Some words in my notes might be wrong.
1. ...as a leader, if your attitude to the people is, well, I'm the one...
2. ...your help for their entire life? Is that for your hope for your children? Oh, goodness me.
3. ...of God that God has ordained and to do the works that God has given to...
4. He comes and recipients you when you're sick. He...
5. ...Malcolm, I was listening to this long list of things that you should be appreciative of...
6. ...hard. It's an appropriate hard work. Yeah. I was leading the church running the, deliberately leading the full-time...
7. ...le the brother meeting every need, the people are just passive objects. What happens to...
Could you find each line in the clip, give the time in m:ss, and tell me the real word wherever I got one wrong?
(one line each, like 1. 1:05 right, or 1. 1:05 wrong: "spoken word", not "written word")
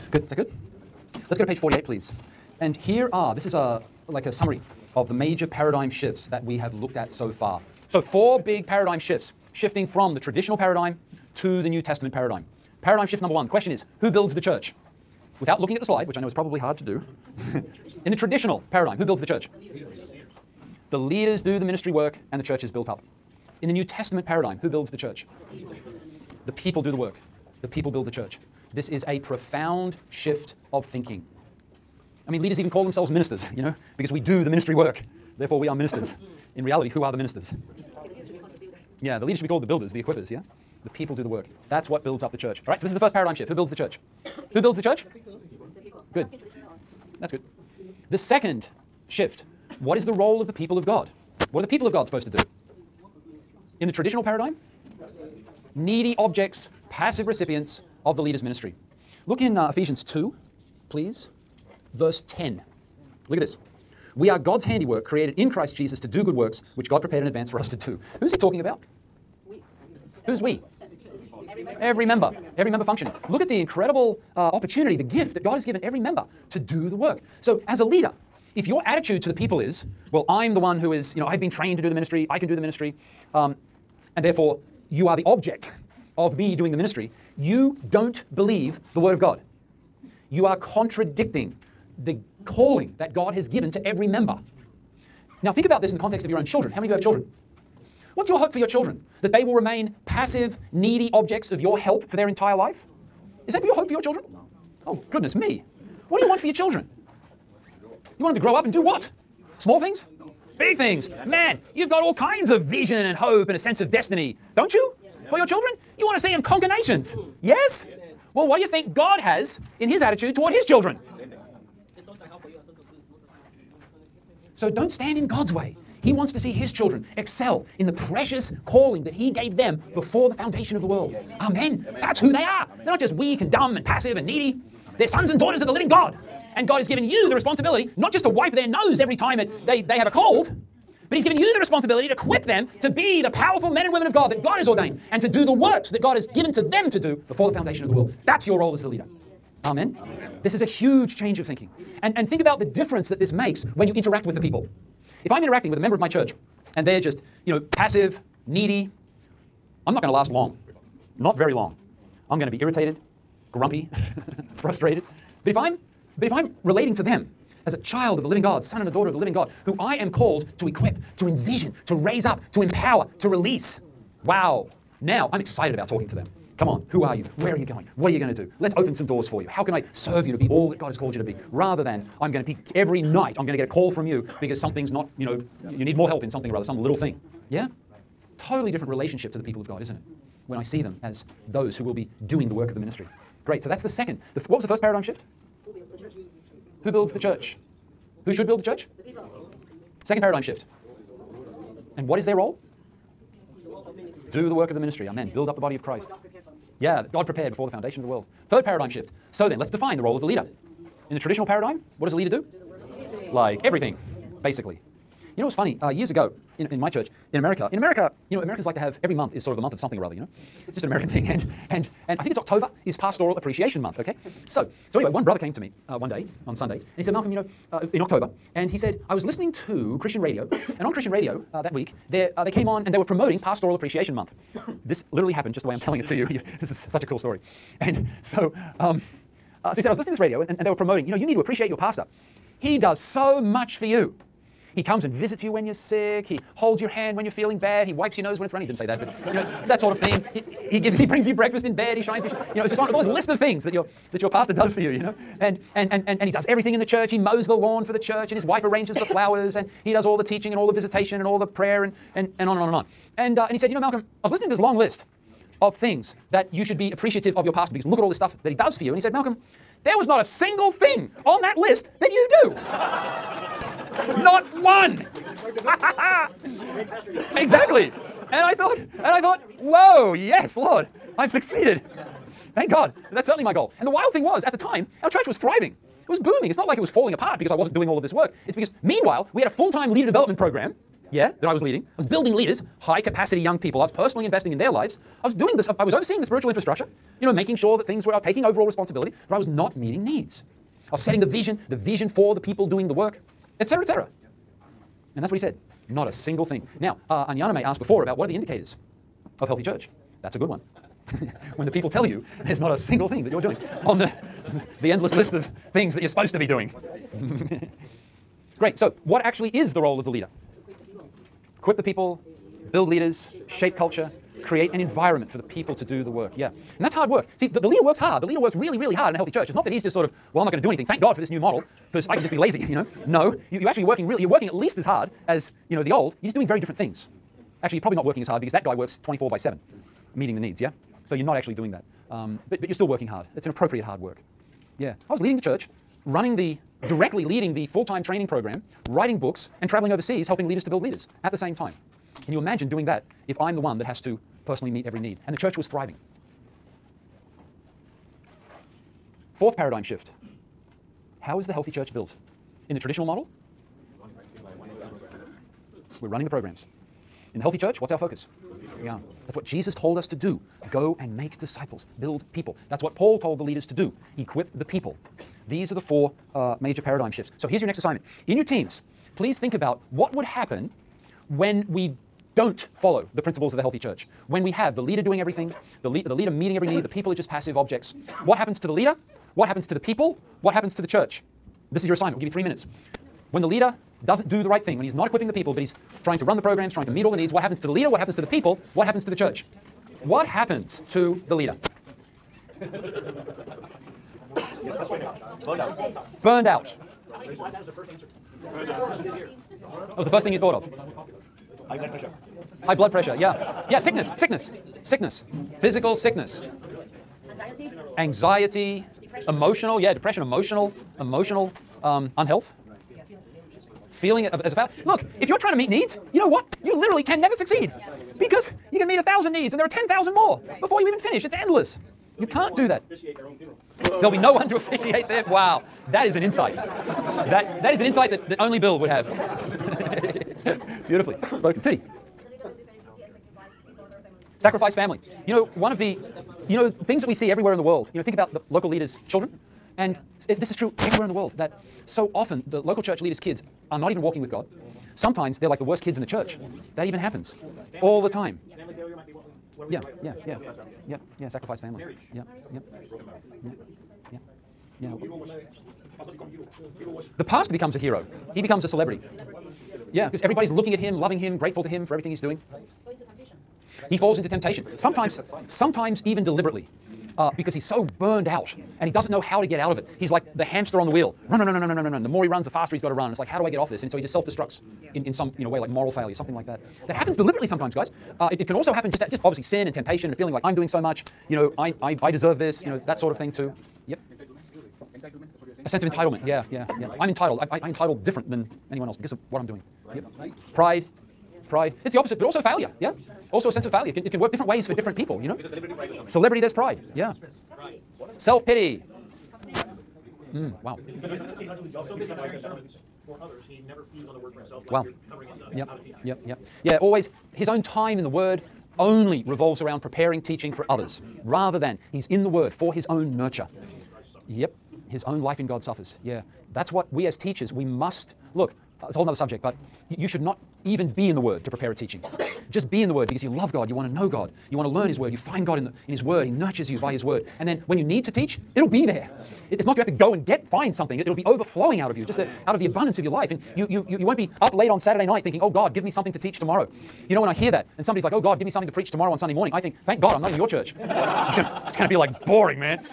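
1. 1:17 right
2. 1:41 right
3. 2:24 right
4. 4:04 wrong: "visits", not "recipients"
5. 4:23 right
6. 5:43 wrong: "directly", not "deliberately"
7. 6:25 wrong: "leader", not "brother".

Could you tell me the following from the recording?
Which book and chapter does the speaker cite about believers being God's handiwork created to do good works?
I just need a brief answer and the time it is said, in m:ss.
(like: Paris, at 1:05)
Ephesians 2, at 0:59.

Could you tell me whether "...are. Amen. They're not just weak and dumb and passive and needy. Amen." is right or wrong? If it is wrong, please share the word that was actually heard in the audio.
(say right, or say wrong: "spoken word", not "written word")
right.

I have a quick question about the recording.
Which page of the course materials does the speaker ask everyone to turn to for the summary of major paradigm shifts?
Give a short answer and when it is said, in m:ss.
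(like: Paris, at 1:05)
48, at 0:01.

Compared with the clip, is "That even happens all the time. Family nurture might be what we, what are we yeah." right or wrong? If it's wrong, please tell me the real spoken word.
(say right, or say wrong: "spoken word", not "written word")
wrong: "failure", not "nurture".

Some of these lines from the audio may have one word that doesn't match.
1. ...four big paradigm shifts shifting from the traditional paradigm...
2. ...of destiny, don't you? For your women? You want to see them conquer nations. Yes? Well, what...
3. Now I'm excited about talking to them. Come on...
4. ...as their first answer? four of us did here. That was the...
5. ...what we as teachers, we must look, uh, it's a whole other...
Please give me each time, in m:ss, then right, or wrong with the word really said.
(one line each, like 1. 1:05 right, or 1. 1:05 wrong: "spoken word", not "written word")
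1. 0:08 right
2. 1:53 wrong: "children", not "women"
3. 2:55 right
4. 6:47 right
5. 8:46 right.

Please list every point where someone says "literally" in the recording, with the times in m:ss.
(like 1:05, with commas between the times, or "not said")
3:55, 7:06.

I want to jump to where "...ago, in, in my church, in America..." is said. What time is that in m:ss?
3:36.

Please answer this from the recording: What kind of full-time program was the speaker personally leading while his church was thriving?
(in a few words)
leader development program.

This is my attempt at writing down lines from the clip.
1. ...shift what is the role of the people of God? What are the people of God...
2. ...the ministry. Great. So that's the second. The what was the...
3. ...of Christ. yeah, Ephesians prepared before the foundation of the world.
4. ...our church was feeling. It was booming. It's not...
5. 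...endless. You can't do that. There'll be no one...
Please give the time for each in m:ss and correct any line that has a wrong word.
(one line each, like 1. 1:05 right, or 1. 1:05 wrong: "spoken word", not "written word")
1. 0:49 right
2. 3:12 right
3. 3:25 wrong: "God", not "Ephesians"
4. 4:45 wrong: "thriving", not "feeling"
5. 7:11 right.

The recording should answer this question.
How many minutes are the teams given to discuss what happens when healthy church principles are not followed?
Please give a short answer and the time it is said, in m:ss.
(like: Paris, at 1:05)
3, at 6:32.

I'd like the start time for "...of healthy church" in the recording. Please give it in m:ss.
5:09.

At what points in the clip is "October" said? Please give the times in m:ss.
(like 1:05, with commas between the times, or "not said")
3:42, 3:48.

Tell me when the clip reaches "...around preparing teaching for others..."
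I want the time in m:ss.
8:39.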